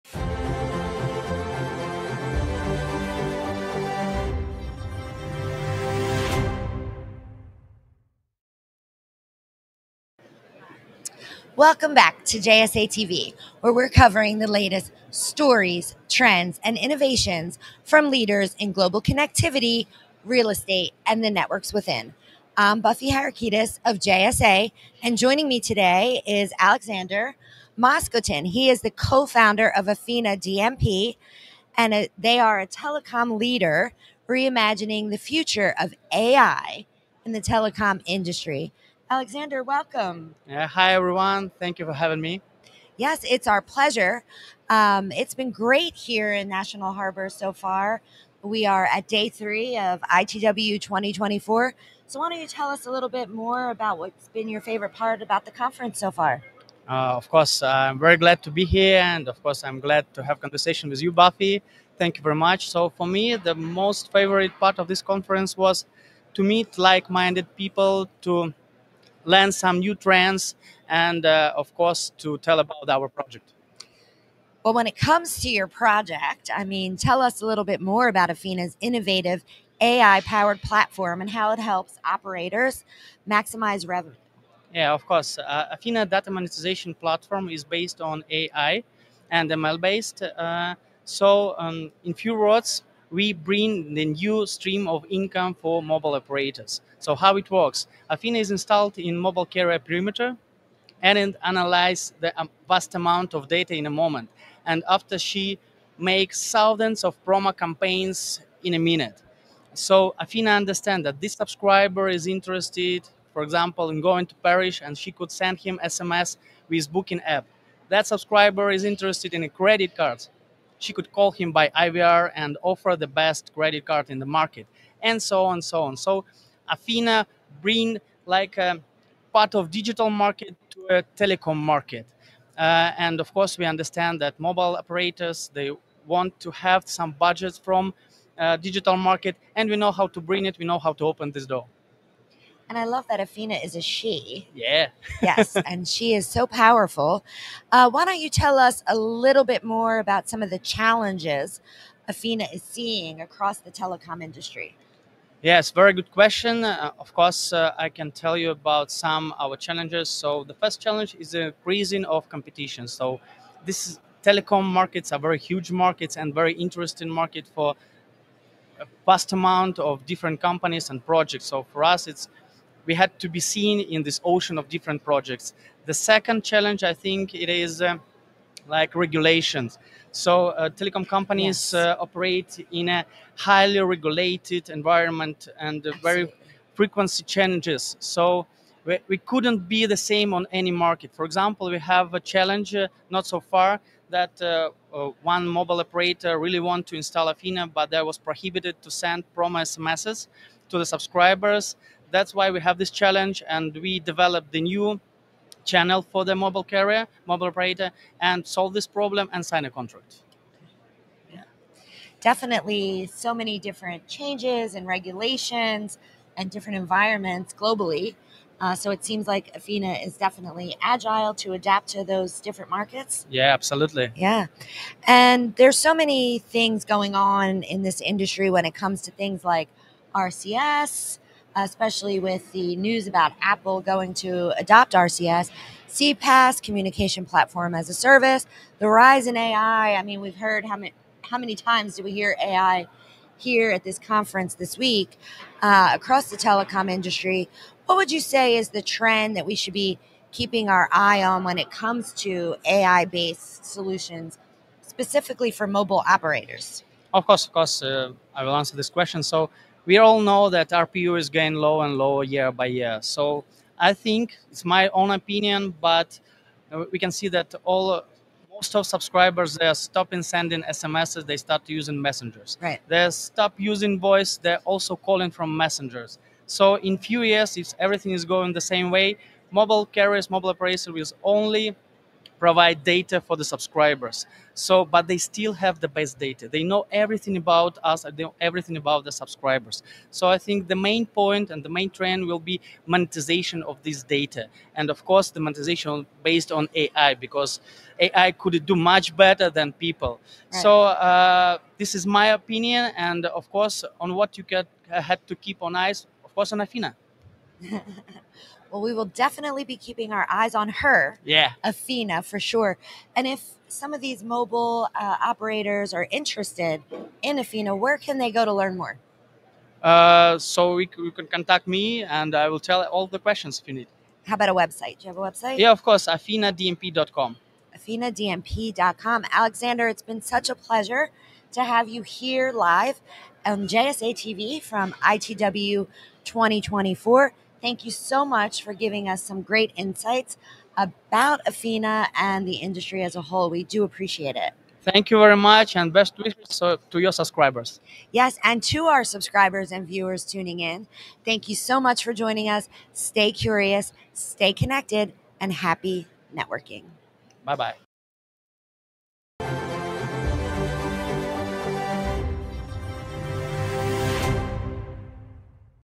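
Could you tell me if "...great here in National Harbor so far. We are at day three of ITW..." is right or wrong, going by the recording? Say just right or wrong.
right.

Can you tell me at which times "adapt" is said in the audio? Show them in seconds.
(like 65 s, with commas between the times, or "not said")
221 s.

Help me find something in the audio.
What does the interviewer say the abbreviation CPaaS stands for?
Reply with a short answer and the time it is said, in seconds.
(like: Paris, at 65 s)
communication platform as a service, at 236 s.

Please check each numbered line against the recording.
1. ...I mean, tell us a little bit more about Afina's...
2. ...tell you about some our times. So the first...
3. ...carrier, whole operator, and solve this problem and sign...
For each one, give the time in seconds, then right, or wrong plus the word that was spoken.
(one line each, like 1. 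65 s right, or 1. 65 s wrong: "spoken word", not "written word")
1. 76 s right
2. 158 s wrong: "challenges", not "times"
3. 206 s wrong: "mobile", not "whole".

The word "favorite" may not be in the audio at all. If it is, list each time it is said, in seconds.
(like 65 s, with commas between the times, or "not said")
54 s, 64 s.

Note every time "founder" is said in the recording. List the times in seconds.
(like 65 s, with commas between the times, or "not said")
29 s.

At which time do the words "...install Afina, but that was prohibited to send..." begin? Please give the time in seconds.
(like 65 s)
196 s.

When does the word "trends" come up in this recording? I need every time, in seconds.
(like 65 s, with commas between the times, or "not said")
16 s, 69 s, 248 s, 291 s.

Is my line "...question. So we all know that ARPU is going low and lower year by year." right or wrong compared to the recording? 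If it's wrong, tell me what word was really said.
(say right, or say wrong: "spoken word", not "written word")
right.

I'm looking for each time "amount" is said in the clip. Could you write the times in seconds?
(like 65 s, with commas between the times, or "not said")
102 s, 169 s.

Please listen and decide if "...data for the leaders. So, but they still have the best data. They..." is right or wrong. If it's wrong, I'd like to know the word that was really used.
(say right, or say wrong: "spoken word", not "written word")
wrong: "subscribers", not "leaders".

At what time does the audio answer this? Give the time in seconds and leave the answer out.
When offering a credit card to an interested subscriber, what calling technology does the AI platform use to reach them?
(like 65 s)
121 s.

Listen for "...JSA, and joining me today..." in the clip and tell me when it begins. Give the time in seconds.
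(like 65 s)
23 s.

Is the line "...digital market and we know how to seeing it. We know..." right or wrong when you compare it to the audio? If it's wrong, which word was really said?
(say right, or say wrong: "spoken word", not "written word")
wrong: "bring", not "seeing".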